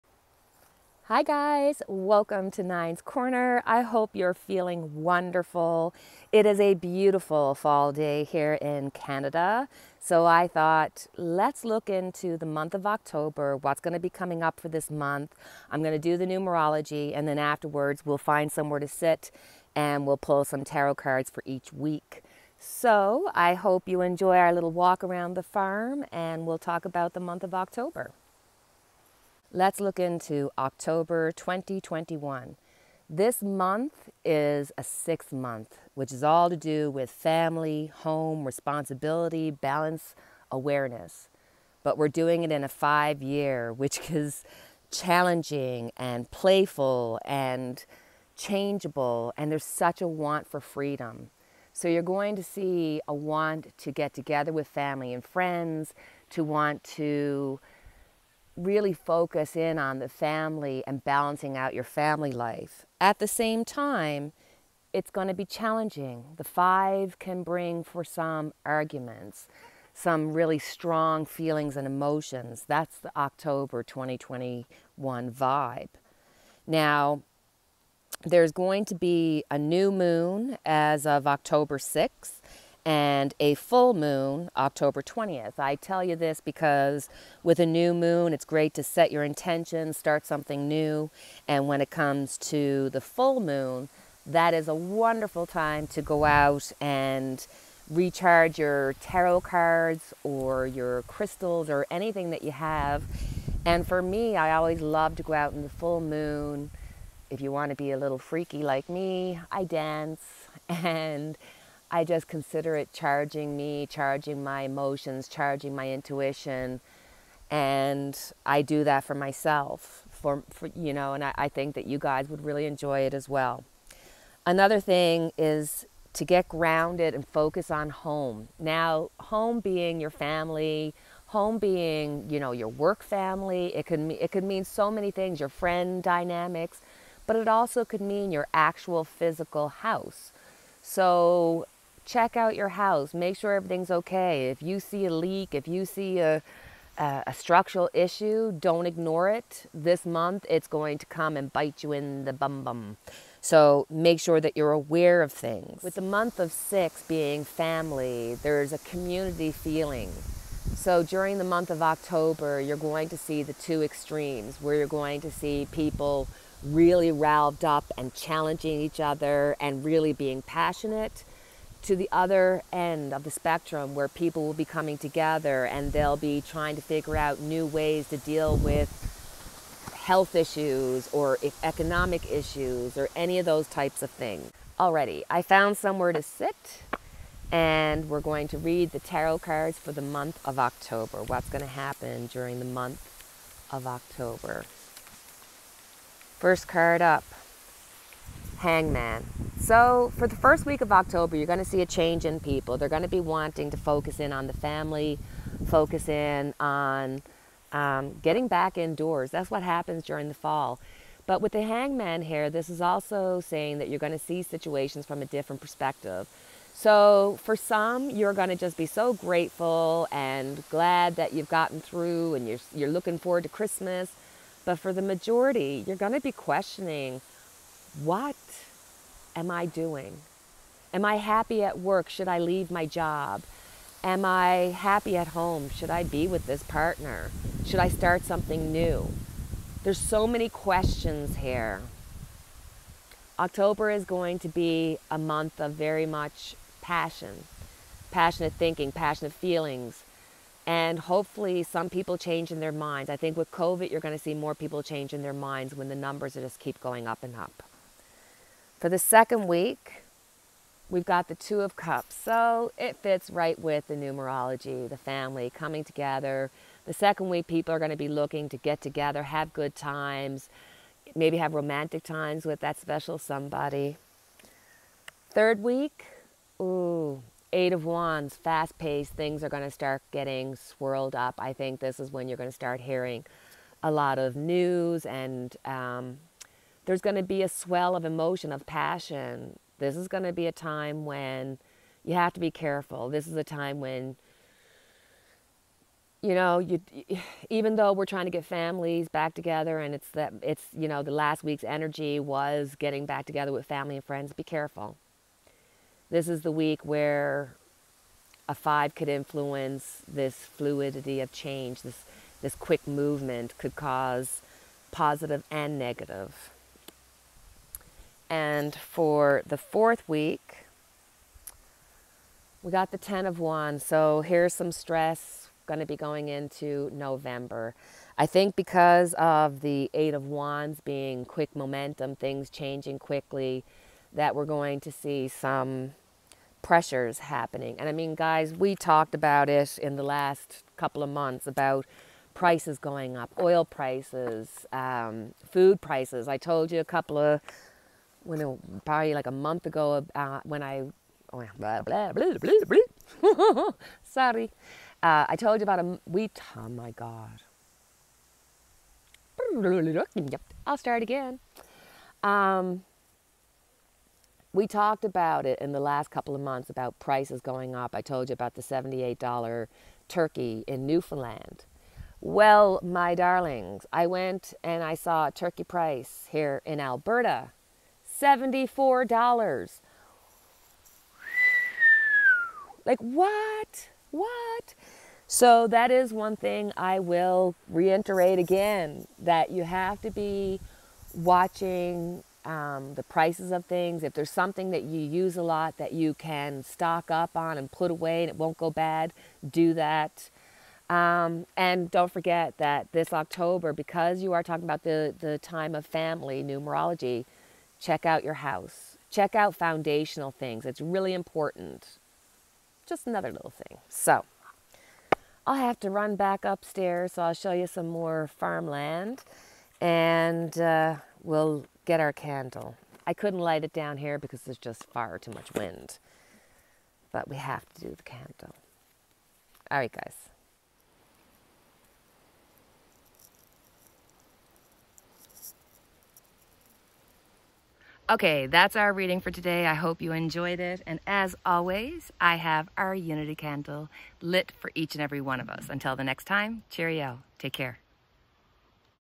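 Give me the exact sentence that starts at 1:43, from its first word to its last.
And for me, I always love to go out in the full moon.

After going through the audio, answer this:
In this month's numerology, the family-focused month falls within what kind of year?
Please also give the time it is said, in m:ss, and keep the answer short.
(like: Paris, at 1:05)
five year, at 0:42.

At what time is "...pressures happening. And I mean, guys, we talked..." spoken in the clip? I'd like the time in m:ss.
5:36.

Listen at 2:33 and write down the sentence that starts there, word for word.
So make sure that you're aware of things.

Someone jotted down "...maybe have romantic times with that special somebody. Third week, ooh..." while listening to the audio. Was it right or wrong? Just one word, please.
right.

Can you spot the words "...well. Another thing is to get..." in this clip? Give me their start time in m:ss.
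2:03.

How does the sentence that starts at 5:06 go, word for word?
This is the week where a 5 could influence this fluidity of change, this this quick movement could cause positive and negative.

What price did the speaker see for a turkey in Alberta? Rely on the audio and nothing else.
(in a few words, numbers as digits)
$74.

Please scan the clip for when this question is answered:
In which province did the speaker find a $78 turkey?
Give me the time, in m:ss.
6:10.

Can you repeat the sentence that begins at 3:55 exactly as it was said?
Should I be with this partner?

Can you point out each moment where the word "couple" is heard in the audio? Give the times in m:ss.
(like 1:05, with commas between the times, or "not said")
5:40, 5:46, 6:06.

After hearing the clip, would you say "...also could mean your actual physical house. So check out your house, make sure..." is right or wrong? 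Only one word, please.
right.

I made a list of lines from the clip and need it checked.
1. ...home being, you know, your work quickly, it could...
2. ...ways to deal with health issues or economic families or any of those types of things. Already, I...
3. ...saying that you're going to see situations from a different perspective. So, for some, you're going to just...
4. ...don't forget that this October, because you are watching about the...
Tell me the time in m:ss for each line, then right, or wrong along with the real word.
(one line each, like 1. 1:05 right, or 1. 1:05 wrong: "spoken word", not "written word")
1. 2:11 wrong: "family", not "quickly"
2. 2:57 wrong: "issues", not "families"
3. 3:33 right
4. 6:41 wrong: "talking", not "watching".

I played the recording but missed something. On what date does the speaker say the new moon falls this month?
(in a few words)
October 6th.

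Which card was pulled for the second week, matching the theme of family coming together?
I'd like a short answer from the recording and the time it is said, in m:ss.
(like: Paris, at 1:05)
Two of Cups, at 4:21.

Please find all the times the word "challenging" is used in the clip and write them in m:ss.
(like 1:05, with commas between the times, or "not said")
0:44, 1:05, 2:48.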